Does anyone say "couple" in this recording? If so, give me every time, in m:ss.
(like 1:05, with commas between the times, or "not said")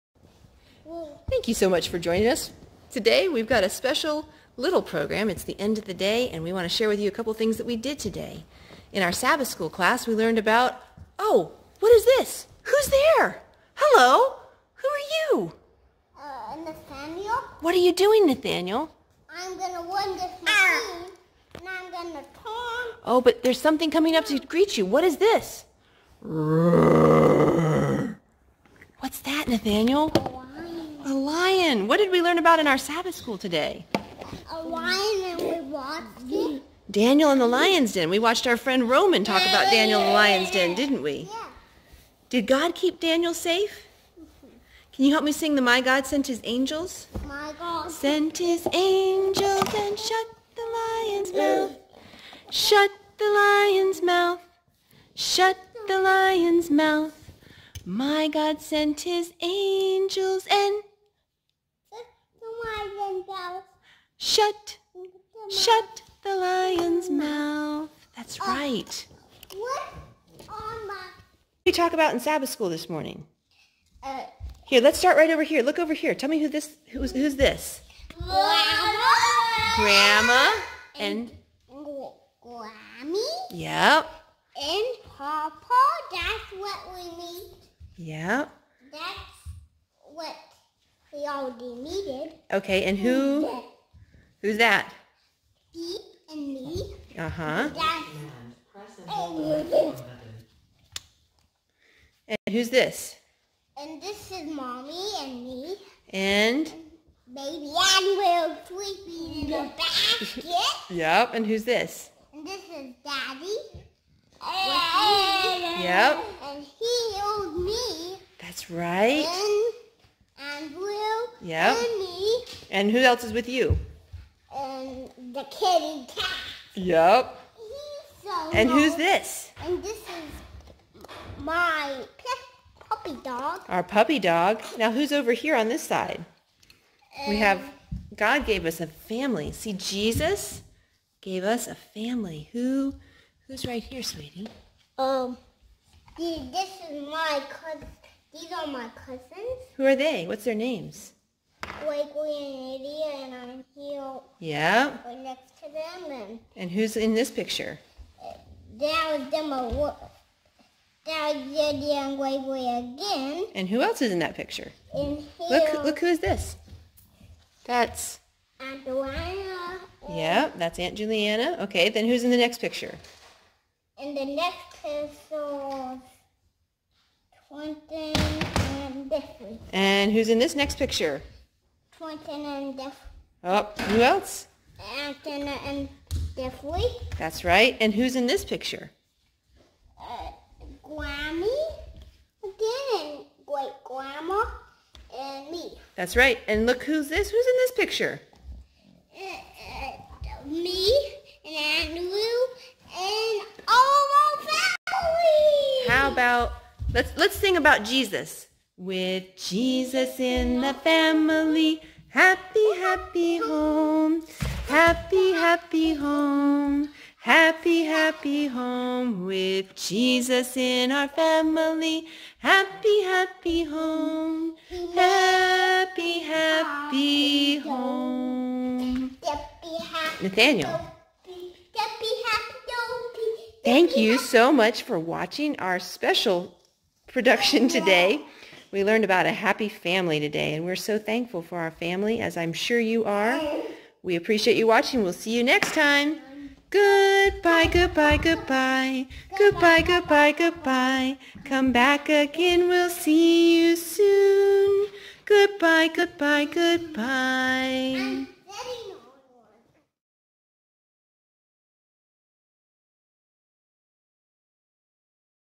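0:07.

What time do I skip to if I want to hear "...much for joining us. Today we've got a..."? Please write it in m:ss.
0:01.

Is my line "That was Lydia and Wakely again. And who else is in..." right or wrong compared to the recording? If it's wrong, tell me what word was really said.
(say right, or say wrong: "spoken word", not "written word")
right.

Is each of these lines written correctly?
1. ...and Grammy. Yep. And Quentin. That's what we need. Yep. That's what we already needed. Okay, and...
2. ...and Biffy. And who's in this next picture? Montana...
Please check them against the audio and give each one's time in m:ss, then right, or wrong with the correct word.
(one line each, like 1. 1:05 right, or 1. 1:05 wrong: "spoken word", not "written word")
1. 1:21 wrong: "Papa", not "Quentin"
2. 2:58 right.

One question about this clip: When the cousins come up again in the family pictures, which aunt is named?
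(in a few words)
Aunt Juliana.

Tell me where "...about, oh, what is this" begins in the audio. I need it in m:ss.
0:10.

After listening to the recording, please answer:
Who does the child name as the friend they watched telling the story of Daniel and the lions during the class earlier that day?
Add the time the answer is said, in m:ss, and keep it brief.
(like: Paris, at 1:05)
Roman, at 0:38.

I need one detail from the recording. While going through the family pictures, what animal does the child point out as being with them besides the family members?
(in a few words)
kitty cat.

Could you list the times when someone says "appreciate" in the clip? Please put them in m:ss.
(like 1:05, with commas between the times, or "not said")
4:04.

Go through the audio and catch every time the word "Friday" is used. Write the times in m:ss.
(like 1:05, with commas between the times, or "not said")
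not said.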